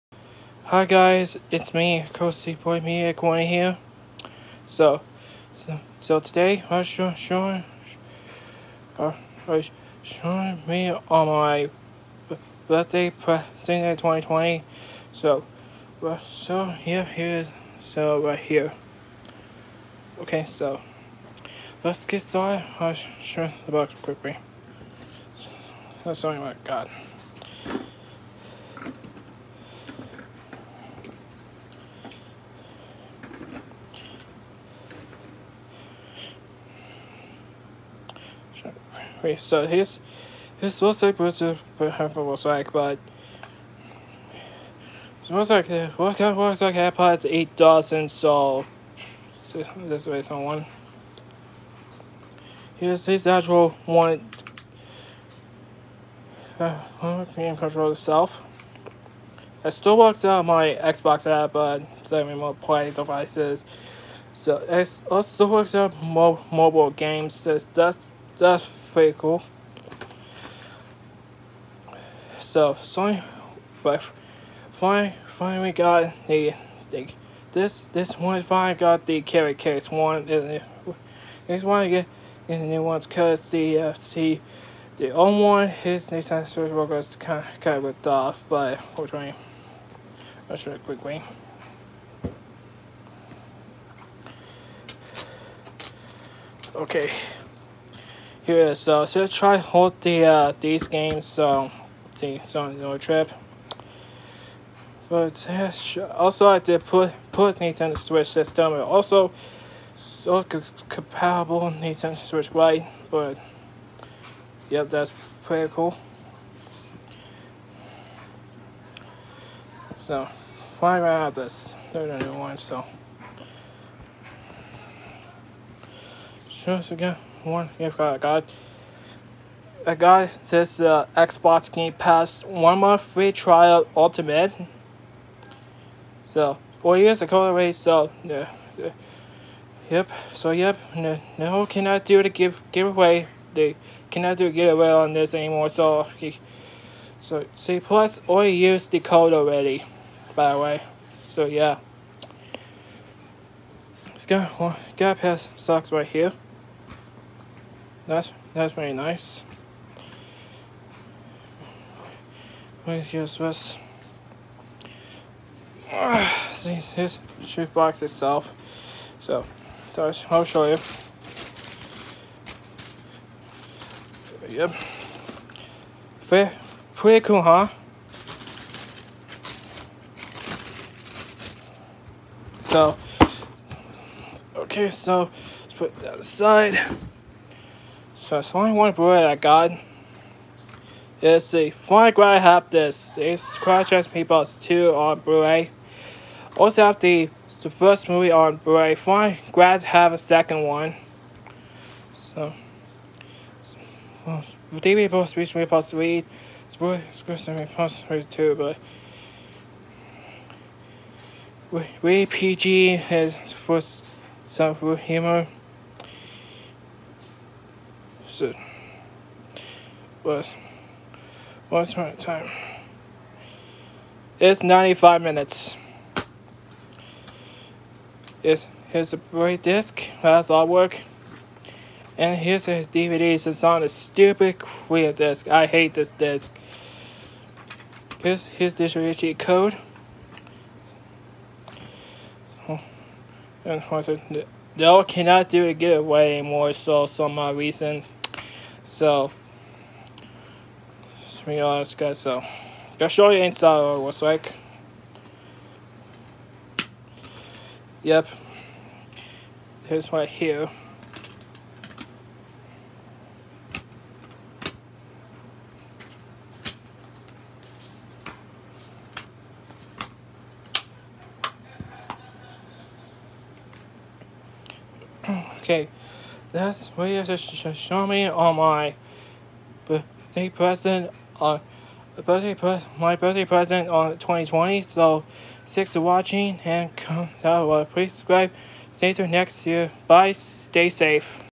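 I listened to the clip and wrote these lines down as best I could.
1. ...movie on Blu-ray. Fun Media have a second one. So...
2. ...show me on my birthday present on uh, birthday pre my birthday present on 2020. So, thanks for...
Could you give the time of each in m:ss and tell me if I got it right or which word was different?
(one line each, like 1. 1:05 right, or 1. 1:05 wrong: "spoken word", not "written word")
1. 3:18 wrong: "Grad", not "Media"
2. 4:37 right.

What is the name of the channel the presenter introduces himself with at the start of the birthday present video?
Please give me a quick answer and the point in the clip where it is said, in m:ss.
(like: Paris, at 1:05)
Cole Seaboy Media Corner, at 0:02.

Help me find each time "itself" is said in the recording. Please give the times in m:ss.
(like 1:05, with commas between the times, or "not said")
0:57, 2:48.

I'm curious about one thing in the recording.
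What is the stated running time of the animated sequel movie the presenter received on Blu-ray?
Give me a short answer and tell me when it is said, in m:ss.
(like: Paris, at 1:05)
95 minutes, at 3:44.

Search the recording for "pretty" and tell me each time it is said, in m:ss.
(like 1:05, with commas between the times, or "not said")
1:08, 1:55, 2:56.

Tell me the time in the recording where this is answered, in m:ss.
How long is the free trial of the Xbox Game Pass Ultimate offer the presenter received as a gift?
2:12.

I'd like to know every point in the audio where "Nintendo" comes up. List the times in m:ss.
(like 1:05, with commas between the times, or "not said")
1:26, 1:47, 1:51.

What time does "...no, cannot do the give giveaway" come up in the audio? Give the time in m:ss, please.
2:21.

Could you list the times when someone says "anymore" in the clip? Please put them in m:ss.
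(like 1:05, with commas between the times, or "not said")
2:25, 4:06.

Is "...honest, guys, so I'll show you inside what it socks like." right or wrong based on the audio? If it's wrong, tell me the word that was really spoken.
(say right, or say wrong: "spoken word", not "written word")
wrong: "looks", not "socks".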